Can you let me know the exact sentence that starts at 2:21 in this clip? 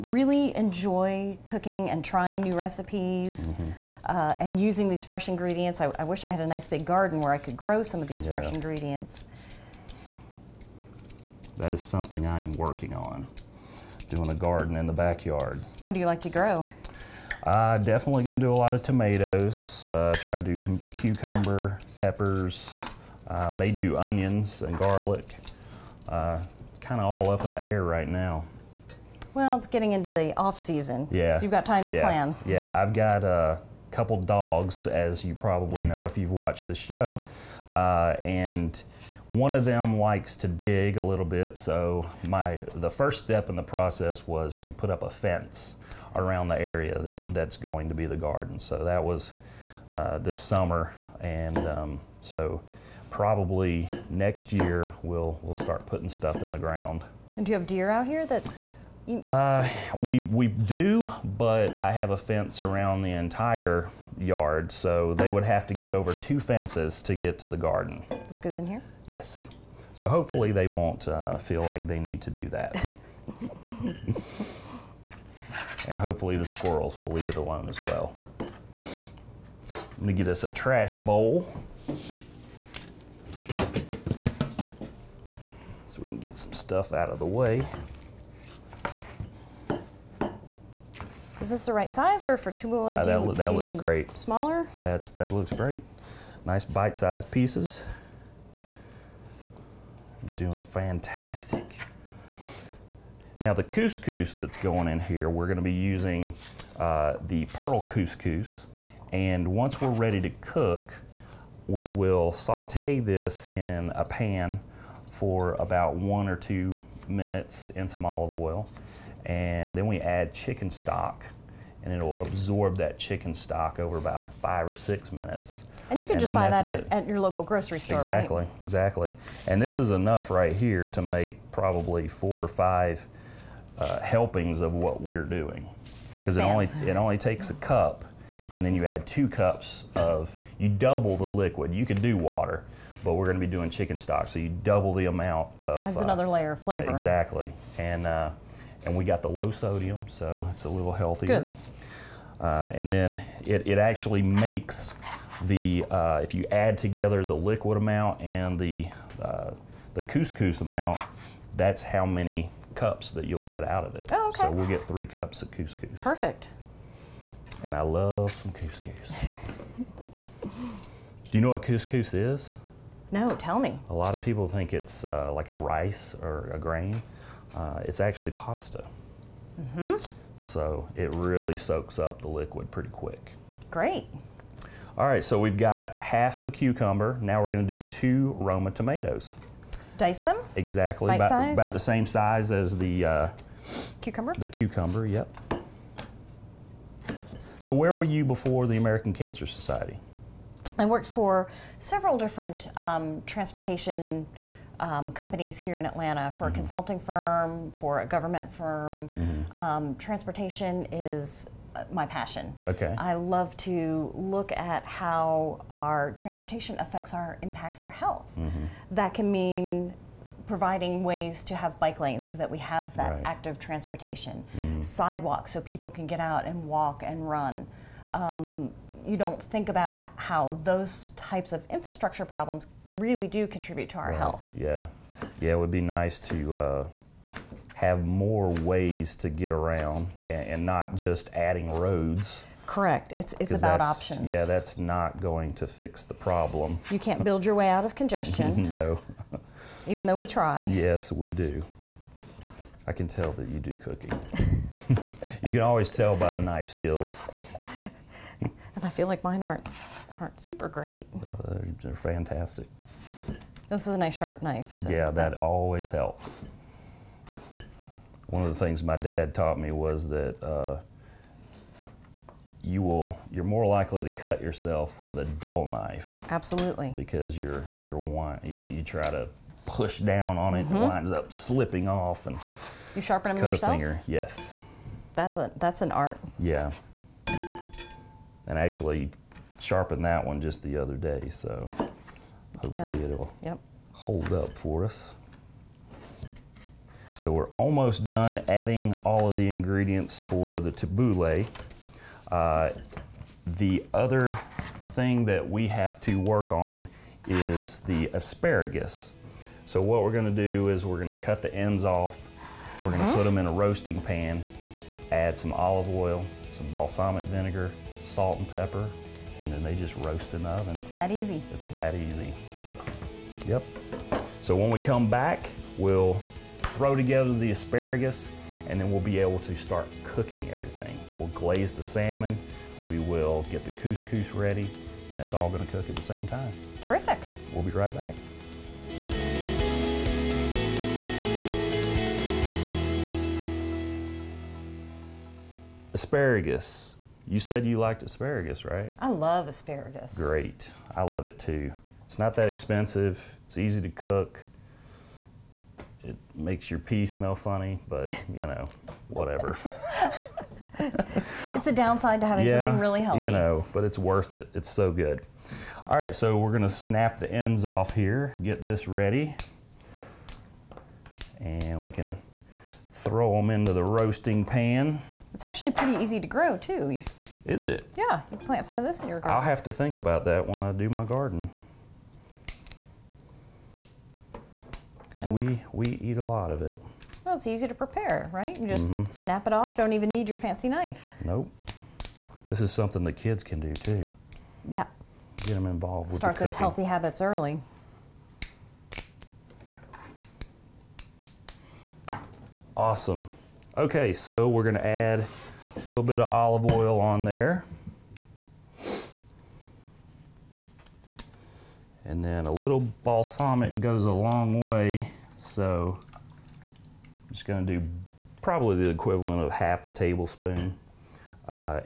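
You could do water, but we're going to be doing chicken stock, so you double the amount of.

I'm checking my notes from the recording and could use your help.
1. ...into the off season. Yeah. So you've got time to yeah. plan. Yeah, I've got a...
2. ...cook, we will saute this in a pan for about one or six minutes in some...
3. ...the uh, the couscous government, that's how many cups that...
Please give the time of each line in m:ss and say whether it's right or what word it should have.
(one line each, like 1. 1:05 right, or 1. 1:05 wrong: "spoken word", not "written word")
1. 0:29 right
2. 1:50 wrong: "two", not "six"
3. 2:38 wrong: "amount", not "government".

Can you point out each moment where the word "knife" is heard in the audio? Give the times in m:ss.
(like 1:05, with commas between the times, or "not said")
4:16, 4:24, 4:35, 6:30.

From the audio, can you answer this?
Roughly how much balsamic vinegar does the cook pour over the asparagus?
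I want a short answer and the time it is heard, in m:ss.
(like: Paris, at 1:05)
half a tablespoon, at 6:59.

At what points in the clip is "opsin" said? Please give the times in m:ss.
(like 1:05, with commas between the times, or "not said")
not said.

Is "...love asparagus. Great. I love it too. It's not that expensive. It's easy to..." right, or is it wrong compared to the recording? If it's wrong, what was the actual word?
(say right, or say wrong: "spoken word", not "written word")
right.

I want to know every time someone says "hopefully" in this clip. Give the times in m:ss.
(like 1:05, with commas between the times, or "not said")
1:10, 1:15, 4:52.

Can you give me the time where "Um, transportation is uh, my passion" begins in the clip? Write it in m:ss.
3:29.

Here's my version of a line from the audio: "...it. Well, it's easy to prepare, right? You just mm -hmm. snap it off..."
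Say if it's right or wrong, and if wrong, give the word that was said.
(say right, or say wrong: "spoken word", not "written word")
right.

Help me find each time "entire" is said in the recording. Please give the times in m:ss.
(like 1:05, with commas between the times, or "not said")
1:03.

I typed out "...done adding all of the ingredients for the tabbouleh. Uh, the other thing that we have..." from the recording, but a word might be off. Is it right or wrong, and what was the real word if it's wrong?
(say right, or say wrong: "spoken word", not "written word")
right.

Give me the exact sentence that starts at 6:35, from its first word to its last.
Get them involved with Start those healthy habits early.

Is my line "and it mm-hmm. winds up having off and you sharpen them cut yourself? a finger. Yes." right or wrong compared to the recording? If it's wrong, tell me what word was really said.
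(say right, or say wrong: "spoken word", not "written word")
wrong: "slipping", not "having".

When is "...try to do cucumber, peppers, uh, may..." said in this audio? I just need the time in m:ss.
0:20.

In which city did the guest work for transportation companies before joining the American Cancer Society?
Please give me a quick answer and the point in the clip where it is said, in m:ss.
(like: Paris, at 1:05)
Atlanta, at 3:25.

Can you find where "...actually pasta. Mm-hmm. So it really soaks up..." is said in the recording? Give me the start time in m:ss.
2:57.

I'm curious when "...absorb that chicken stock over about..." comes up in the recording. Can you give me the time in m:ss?
2:02.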